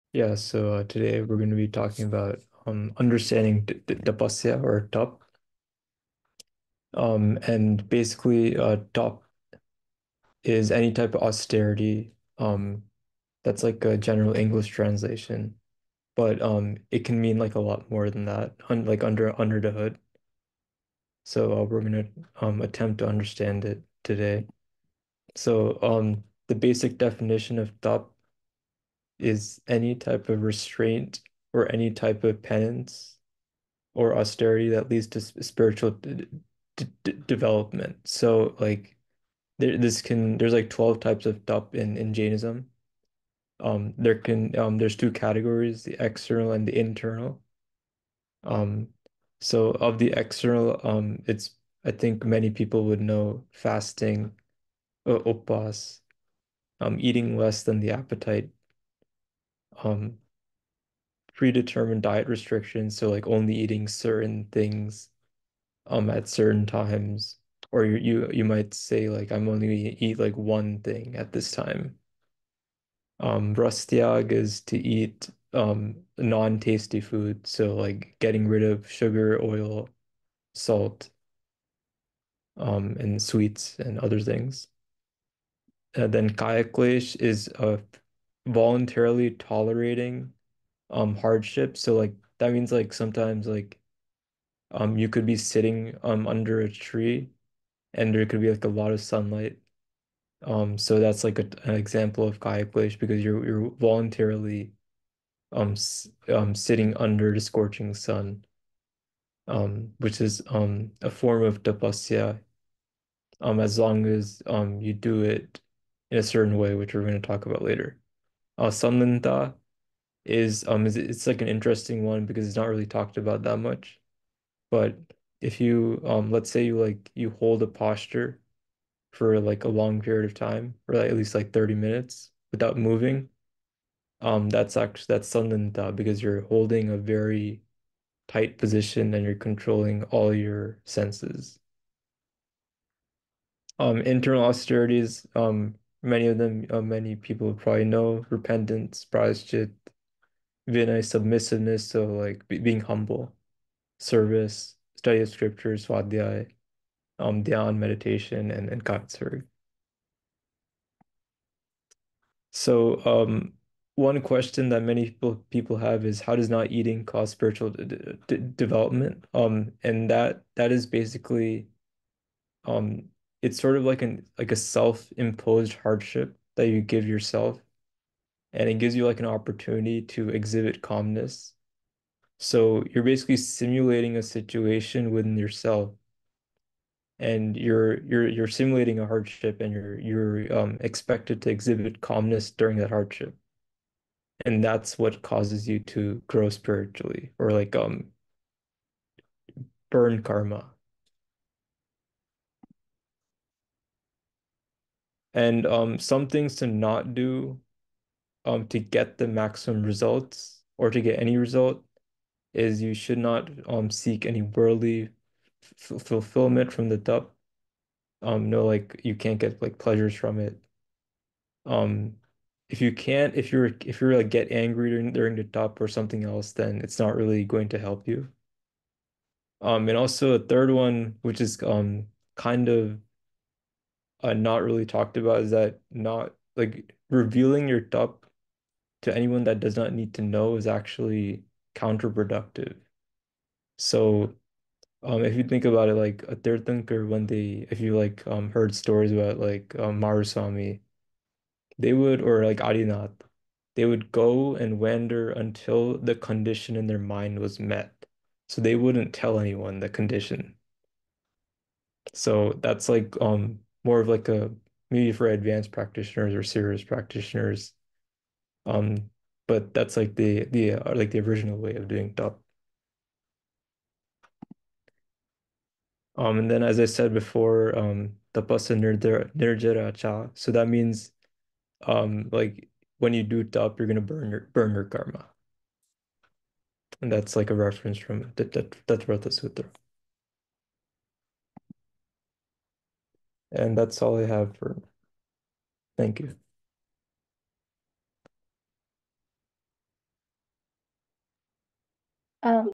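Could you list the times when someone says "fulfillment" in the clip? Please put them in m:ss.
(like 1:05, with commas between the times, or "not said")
3:35.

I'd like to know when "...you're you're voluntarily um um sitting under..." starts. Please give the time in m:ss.
1:43.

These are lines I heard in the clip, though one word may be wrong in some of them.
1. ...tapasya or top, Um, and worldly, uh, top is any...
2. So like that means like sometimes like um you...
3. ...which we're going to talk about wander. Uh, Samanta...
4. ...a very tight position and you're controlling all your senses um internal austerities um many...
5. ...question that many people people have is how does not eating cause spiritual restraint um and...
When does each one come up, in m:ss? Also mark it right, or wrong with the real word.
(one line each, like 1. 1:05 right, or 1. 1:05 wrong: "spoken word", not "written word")
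1. 0:03 wrong: "basically", not "worldly"
2. 1:31 right
3. 1:56 wrong: "later", not "wander"
4. 2:16 right
5. 2:44 wrong: "development", not "restraint".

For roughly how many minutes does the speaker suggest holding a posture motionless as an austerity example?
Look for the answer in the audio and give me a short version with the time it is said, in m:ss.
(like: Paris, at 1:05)
30, at 2:11.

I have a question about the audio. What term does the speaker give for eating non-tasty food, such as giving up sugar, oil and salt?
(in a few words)
rastiag.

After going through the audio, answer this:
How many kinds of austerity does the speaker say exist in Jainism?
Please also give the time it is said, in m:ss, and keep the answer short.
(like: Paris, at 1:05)
12, at 0:40.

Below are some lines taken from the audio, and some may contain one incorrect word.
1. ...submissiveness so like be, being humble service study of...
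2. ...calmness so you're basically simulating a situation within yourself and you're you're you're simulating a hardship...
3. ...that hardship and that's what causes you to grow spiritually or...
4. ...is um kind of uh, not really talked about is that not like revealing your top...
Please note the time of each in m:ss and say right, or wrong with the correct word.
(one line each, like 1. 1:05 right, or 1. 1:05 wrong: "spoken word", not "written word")
1. 2:31 right
2. 3:00 right
3. 3:12 right
4. 3:51 right.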